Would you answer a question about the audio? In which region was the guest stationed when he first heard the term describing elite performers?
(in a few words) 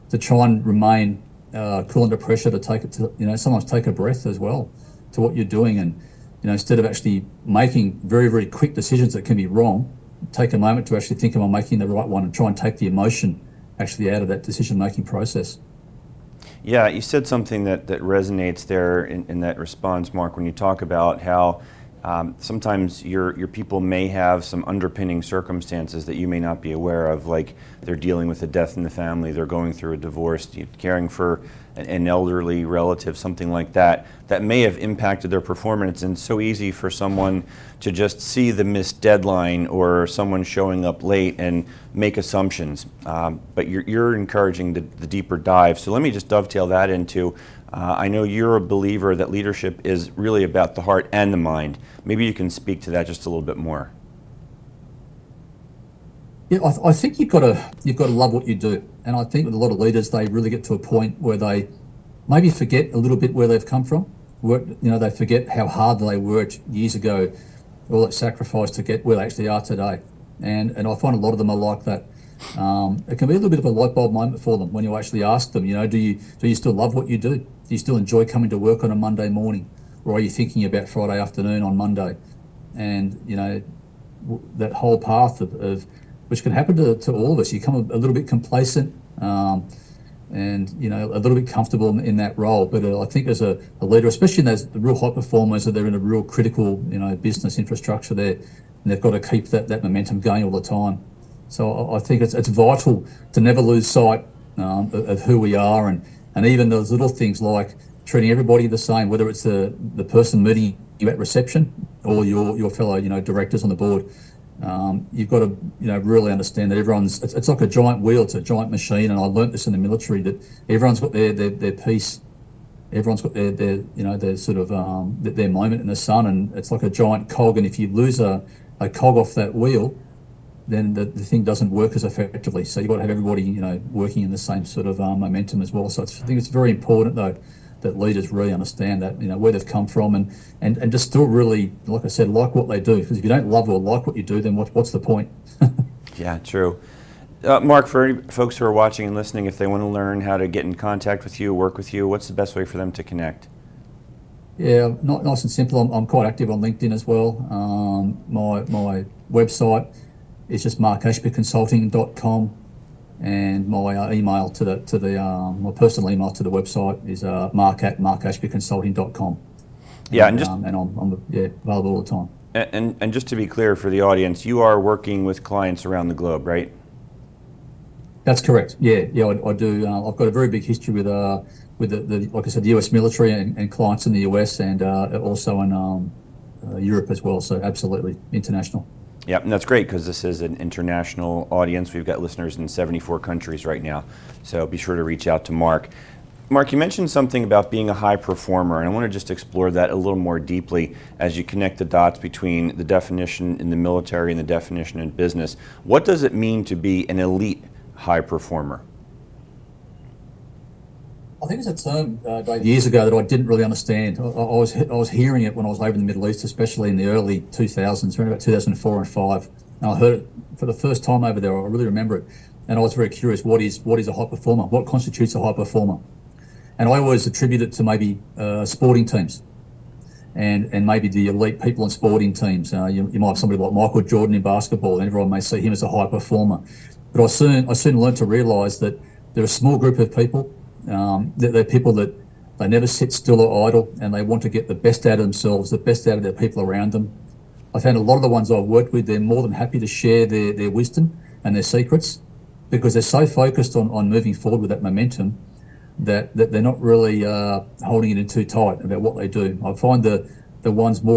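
Middle East.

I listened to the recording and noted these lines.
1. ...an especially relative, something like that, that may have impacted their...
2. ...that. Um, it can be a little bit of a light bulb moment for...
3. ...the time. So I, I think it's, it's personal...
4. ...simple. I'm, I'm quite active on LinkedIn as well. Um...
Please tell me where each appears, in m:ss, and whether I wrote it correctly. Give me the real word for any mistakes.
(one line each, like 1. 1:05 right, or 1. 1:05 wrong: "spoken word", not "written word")
1. 0:31 wrong: "elderly", not "especially"
2. 1:11 right
3. 1:40 wrong: "vital", not "personal"
4. 2:35 right.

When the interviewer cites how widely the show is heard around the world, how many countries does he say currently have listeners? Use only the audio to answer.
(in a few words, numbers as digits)
74.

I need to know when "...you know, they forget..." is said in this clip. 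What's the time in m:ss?
1:04.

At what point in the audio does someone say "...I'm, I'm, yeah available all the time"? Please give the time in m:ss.
2:50.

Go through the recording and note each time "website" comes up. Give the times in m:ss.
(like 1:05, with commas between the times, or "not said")
2:39, 2:46.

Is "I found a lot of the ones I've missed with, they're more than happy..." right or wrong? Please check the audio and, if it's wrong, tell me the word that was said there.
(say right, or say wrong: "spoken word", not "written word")
wrong: "worked", not "missed".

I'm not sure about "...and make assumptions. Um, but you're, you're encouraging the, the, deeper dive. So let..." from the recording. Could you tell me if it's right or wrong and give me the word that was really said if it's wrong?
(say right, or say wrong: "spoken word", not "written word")
right.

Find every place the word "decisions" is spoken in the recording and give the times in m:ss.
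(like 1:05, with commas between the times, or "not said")
0:08, 0:14.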